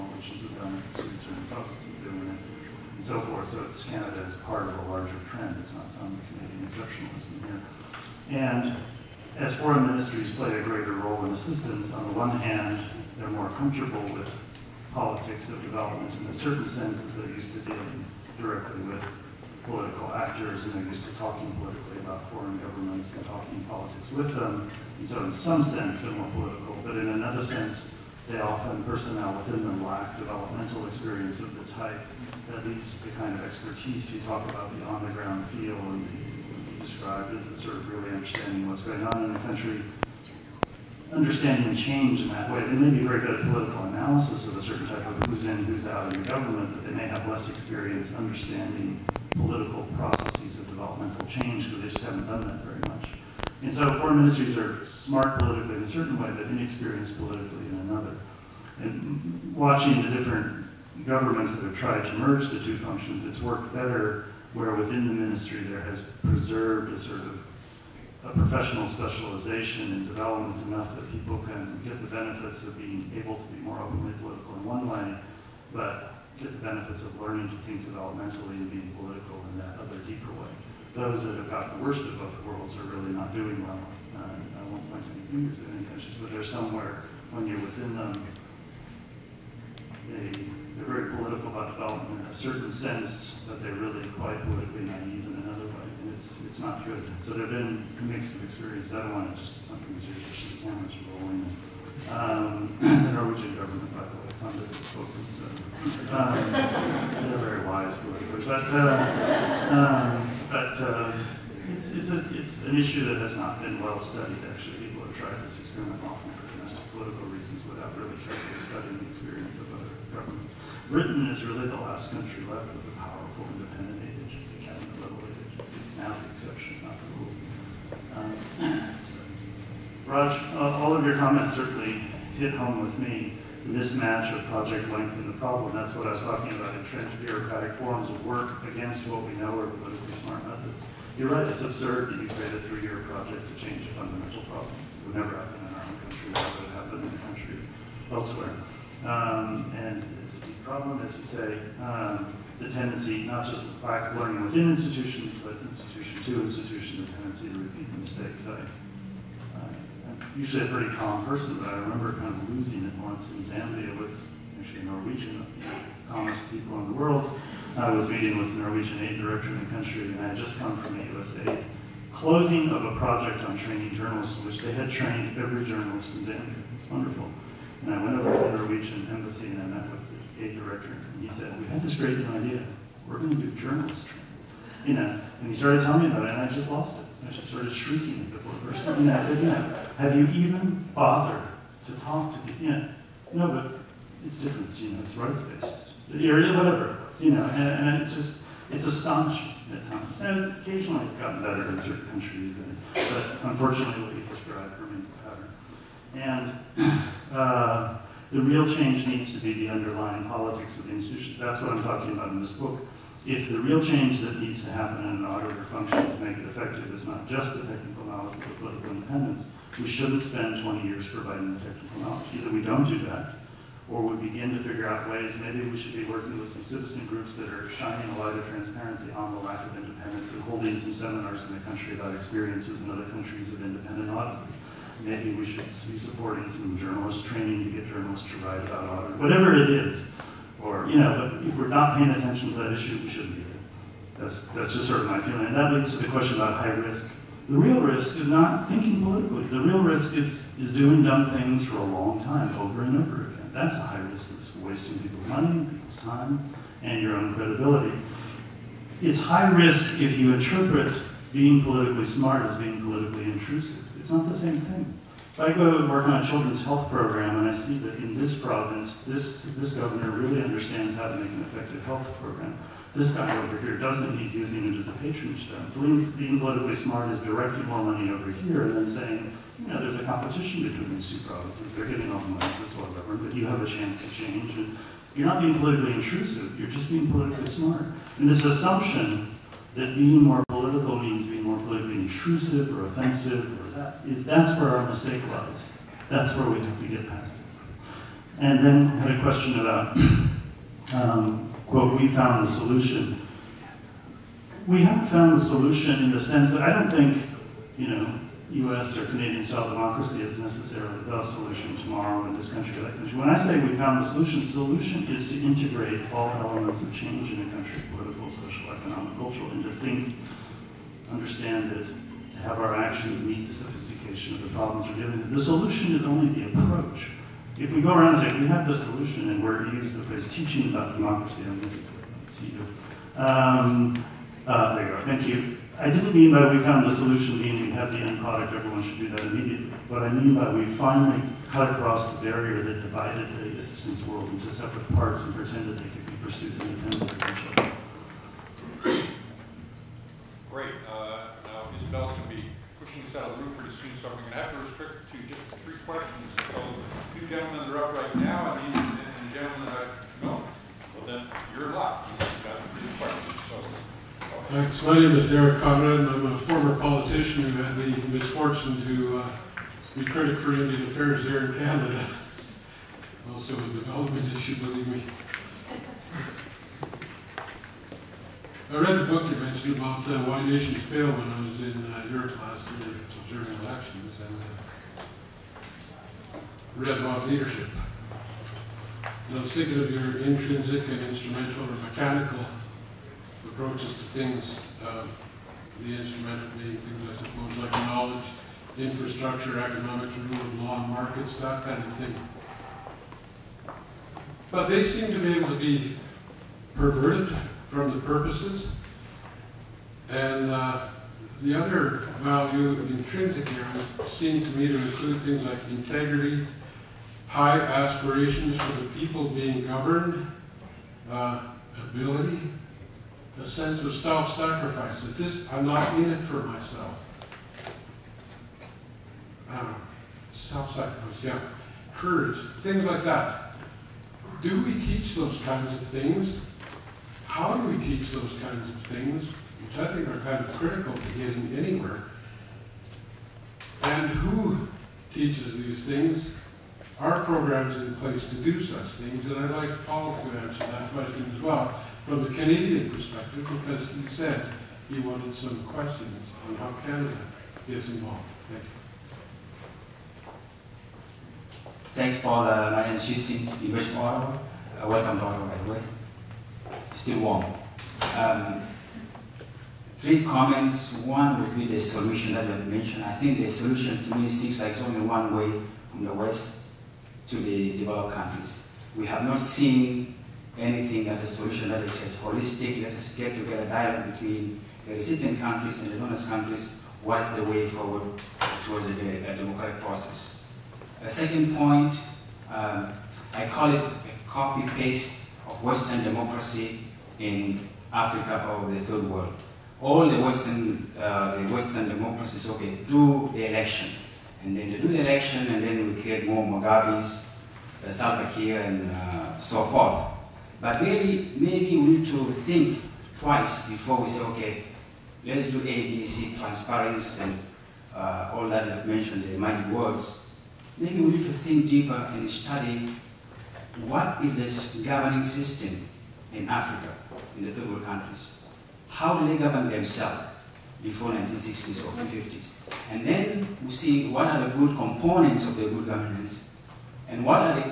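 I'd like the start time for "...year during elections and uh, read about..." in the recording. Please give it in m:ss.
6:22.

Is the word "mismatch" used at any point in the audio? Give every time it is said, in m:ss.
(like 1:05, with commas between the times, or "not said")
2:13.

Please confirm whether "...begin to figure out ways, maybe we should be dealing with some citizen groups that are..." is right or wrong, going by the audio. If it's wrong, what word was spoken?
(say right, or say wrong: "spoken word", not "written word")
wrong: "working", not "dealing".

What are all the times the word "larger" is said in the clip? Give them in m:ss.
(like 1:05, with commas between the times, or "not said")
0:04.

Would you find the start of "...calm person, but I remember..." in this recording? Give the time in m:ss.
2:40.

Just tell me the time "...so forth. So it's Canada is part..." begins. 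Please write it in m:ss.
0:03.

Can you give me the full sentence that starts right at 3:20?
And occasionally it's gotten better in certain countries, and, but unfortunately what you described remains the pattern.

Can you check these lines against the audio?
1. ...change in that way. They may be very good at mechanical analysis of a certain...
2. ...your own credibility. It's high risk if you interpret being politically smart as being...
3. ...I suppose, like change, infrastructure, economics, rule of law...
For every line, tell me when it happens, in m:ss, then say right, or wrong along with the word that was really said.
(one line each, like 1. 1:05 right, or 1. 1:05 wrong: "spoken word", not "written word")
1. 0:41 wrong: "political", not "mechanical"
2. 4:17 right
3. 6:37 wrong: "knowledge", not "change".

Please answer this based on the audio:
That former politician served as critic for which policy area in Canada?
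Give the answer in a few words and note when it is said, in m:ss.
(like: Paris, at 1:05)
Indian Affairs, at 6:10.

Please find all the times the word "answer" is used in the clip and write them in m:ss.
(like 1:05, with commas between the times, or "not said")
7:30.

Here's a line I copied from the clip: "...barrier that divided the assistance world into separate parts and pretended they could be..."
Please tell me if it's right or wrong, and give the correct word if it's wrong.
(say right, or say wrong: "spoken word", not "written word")
right.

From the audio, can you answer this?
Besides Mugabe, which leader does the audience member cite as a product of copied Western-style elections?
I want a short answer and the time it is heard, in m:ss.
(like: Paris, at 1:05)
Salva Kiir, at 8:27.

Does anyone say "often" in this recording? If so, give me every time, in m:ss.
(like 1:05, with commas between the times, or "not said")
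0:28, 1:56.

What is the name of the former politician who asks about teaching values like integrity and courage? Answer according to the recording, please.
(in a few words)
Derrek Konrad.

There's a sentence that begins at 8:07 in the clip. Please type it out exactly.
What's the way forward towards a, a democratic process?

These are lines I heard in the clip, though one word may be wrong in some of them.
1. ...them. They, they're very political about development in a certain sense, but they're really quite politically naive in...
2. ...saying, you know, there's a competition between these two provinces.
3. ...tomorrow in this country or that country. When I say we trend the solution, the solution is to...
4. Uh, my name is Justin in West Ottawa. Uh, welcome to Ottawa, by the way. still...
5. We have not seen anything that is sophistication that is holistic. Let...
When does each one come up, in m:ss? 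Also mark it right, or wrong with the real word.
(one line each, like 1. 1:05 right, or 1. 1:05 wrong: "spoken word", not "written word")
1. 1:27 right
2. 4:38 right
3. 5:11 wrong: "found", not "trend"
4. 7:42 right
5. 7:58 wrong: "solution", not "sophistication".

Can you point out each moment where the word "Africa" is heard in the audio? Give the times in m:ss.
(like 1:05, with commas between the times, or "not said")
8:17, 8:46.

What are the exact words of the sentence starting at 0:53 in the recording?
And so foreign ministries are smart politically in a certain way, but inexperienced politically in another.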